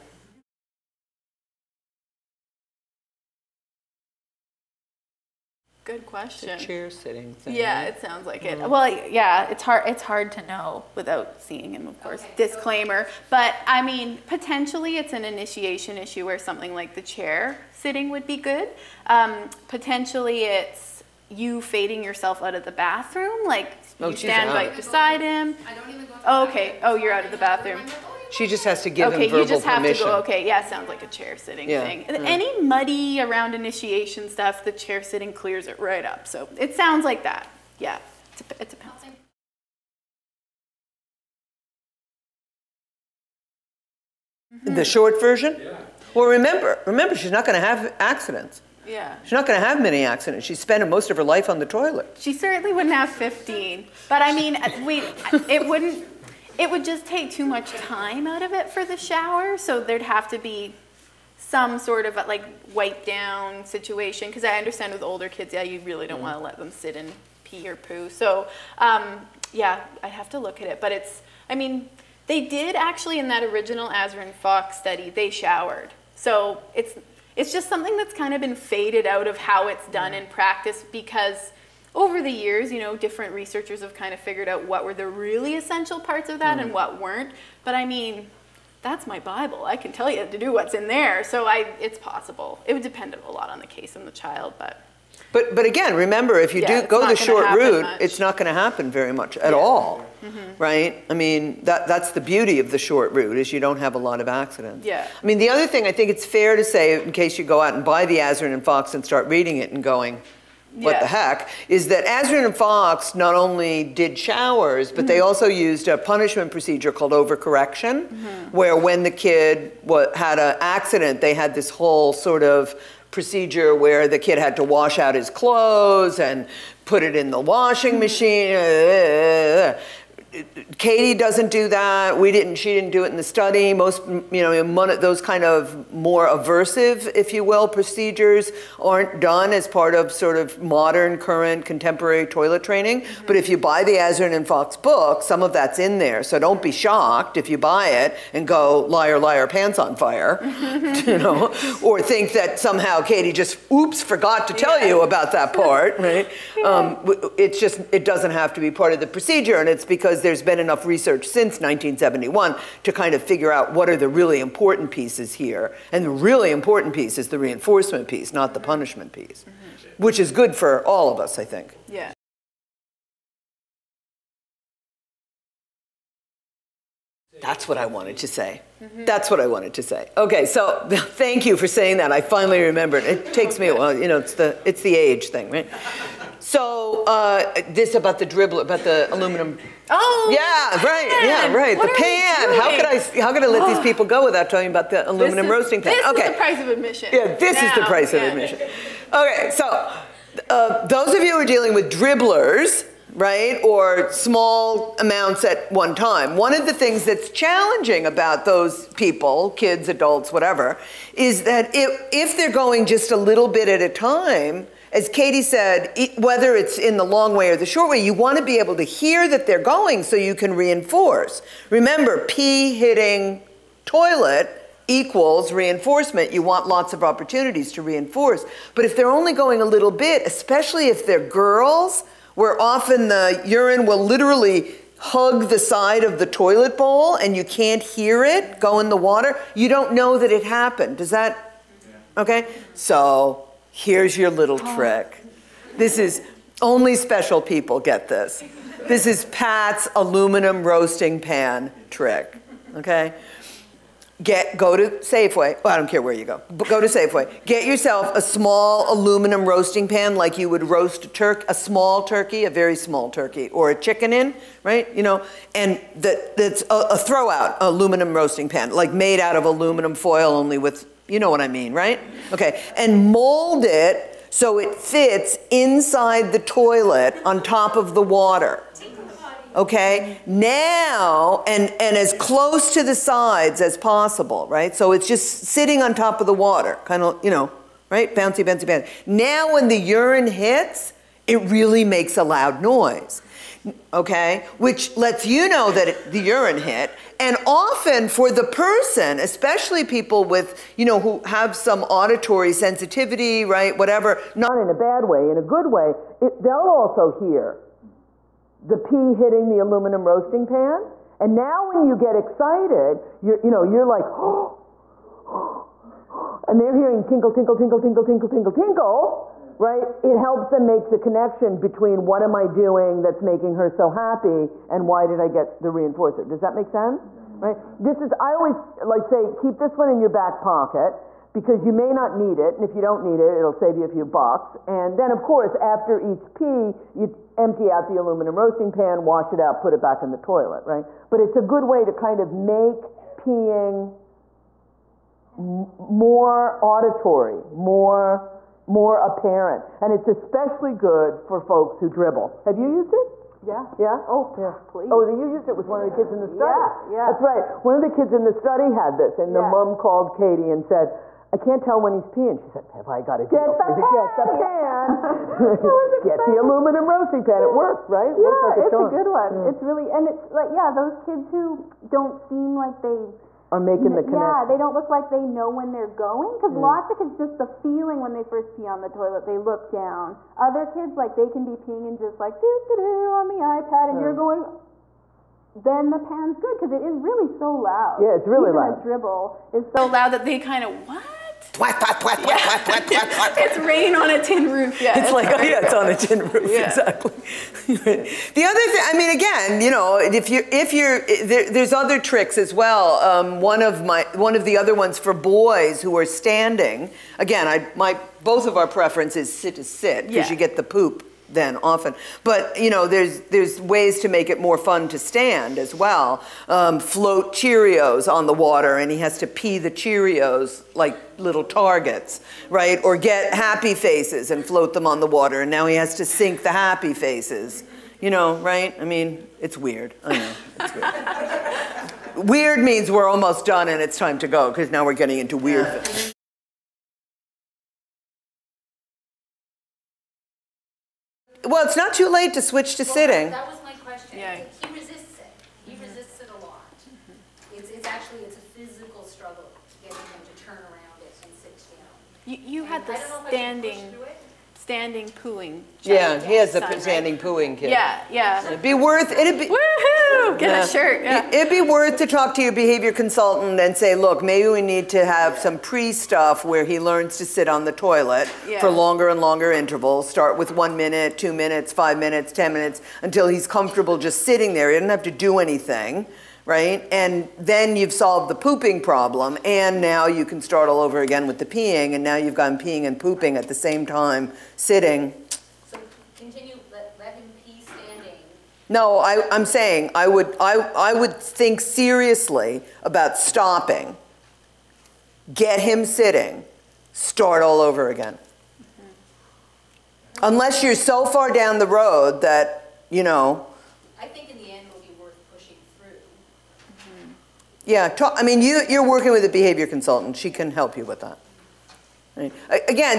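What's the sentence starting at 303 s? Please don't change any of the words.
Whatever, not in a bad way, in a good way, it, they'll also hear the pea hitting the aluminum roasting pan.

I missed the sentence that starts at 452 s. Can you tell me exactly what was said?
You, you had the standing standing pooing.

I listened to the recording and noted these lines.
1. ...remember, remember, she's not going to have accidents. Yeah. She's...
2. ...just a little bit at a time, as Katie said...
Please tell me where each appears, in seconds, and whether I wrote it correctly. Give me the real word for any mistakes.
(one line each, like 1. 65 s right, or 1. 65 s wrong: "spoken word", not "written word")
1. 46 s right
2. 212 s right.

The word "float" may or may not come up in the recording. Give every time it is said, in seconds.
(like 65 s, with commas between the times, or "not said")
416 s, 424 s.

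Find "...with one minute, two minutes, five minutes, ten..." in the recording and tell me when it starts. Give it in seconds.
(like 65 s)
470 s.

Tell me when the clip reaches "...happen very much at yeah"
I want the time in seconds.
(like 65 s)
98 s.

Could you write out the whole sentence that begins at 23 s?
Like, oh, you stand right beside him?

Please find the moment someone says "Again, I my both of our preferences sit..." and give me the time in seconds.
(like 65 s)
407 s.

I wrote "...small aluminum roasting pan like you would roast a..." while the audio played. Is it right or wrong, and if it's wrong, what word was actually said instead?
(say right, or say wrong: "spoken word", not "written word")
right.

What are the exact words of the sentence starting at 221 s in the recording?
Remember, P hitting toilet equals reinforcement.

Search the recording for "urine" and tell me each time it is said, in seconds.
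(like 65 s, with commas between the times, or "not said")
233 s, 289 s, 296 s.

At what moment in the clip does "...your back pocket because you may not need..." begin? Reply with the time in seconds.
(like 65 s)
330 s.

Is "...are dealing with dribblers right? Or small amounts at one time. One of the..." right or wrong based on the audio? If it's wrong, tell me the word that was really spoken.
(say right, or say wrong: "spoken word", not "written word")
right.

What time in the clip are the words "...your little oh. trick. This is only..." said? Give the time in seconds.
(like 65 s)
244 s.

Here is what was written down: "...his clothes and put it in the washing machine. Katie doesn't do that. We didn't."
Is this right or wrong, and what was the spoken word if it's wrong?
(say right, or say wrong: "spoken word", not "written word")
right.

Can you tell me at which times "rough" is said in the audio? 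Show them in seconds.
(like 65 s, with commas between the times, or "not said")
not said.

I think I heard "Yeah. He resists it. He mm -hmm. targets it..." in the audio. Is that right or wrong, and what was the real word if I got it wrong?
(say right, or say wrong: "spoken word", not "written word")
wrong: "resists", not "targets".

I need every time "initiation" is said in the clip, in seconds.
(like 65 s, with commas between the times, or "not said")
15 s, 33 s.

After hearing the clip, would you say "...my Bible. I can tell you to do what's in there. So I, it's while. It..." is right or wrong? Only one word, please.
wrong.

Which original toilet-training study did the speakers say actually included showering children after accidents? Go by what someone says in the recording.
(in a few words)
Azrin Foxx study.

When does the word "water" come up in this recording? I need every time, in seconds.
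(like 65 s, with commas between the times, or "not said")
238 s, 278 s, 286 s, 418 s, 425 s.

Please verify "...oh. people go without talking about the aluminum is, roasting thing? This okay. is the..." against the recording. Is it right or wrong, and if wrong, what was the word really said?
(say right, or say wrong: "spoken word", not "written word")
right.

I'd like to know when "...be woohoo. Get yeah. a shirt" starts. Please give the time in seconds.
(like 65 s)
459 s.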